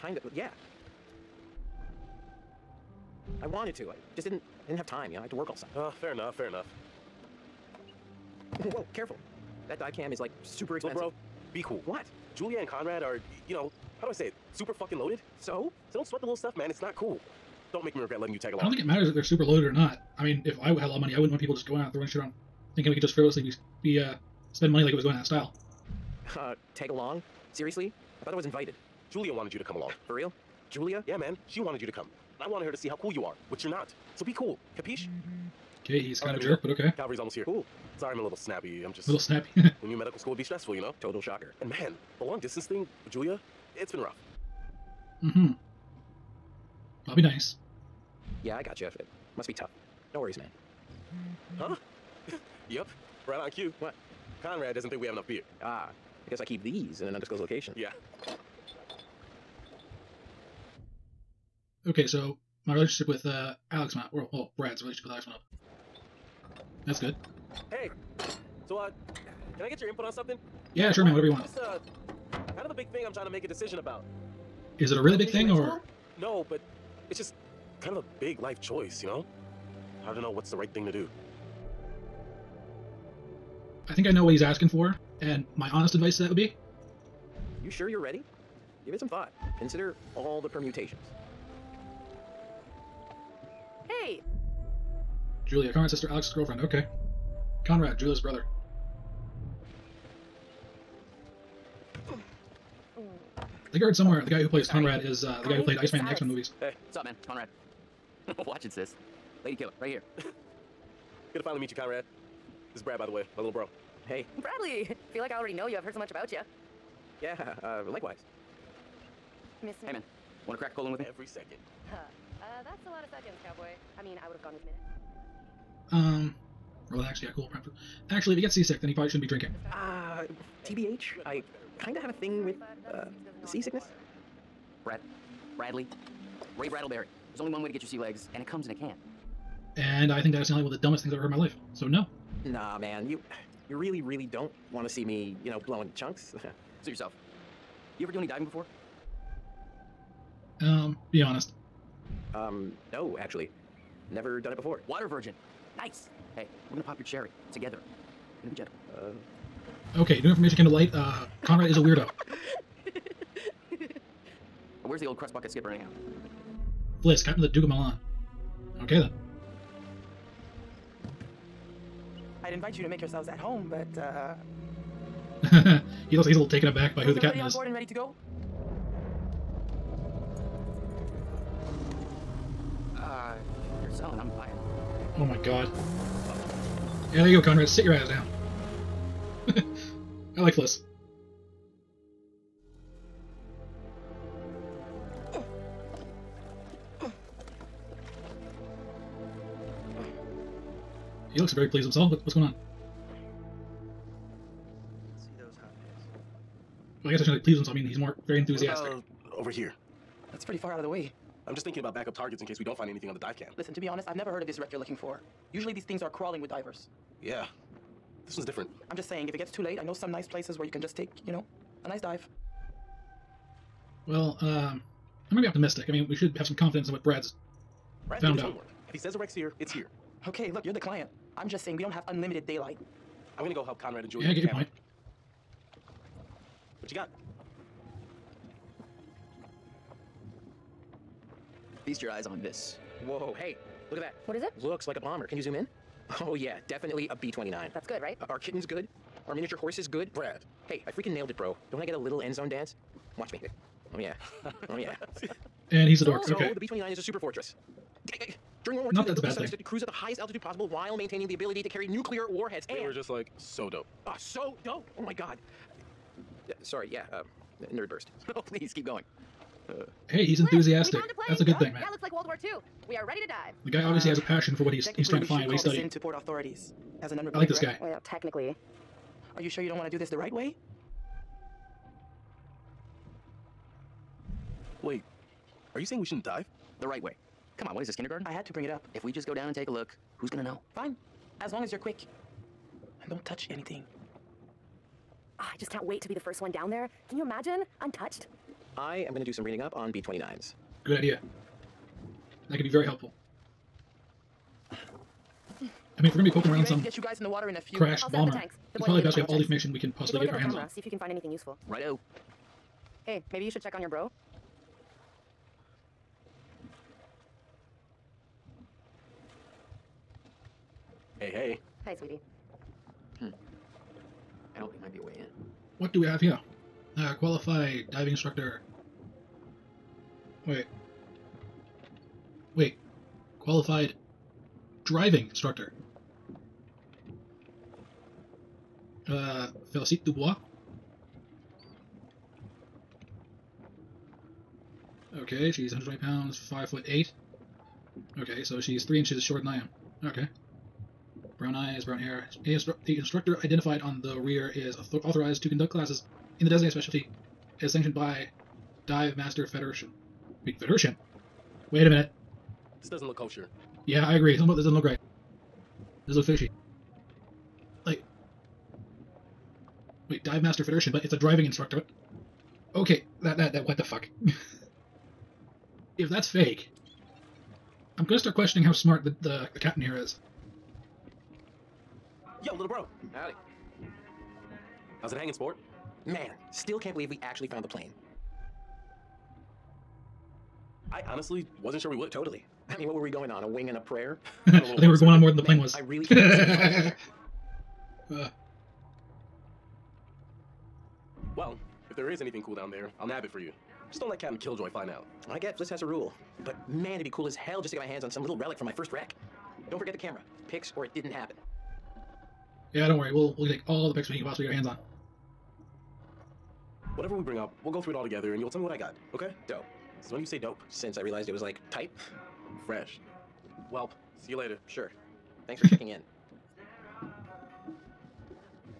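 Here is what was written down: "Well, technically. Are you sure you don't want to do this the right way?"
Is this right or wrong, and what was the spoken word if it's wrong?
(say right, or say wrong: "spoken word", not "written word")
right.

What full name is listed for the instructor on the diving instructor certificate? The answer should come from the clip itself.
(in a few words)
Felicite Dubois.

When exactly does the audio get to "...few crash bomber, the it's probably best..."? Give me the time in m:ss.
5:07.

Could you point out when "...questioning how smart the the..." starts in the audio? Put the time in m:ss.
6:18.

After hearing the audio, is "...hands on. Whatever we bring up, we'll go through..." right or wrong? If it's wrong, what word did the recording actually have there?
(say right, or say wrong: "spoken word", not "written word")
right.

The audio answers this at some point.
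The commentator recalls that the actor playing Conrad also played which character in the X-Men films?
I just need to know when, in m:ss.
1:45.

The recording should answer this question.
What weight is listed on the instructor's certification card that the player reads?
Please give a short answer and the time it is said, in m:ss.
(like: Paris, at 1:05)
120 pounds, at 5:45.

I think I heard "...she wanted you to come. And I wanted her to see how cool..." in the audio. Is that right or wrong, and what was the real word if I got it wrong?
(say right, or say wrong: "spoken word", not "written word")
right.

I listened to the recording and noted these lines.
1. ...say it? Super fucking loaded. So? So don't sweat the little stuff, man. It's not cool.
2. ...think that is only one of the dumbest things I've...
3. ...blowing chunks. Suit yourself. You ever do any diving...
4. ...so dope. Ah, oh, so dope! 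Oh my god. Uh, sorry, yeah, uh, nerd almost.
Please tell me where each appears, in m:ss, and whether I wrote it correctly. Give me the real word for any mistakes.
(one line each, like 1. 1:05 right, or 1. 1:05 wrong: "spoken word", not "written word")
1. 0:14 right
2. 2:20 right
3. 2:25 right
4. 4:23 wrong: "burst", not "almost".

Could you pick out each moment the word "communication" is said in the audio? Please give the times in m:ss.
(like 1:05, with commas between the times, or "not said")
not said.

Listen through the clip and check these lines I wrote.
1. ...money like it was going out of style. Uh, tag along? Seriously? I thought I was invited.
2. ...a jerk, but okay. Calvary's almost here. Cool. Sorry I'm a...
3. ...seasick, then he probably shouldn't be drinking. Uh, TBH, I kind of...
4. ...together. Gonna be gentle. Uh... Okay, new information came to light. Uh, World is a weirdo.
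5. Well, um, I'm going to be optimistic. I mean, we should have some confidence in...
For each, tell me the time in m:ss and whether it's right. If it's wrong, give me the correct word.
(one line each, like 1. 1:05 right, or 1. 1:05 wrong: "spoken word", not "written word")
1. 0:24 right
2. 0:36 right
3. 2:08 right
4. 2:37 wrong: "Conrad", not "World"
5. 3:44 right.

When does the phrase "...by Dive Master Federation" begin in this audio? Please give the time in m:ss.
5:57.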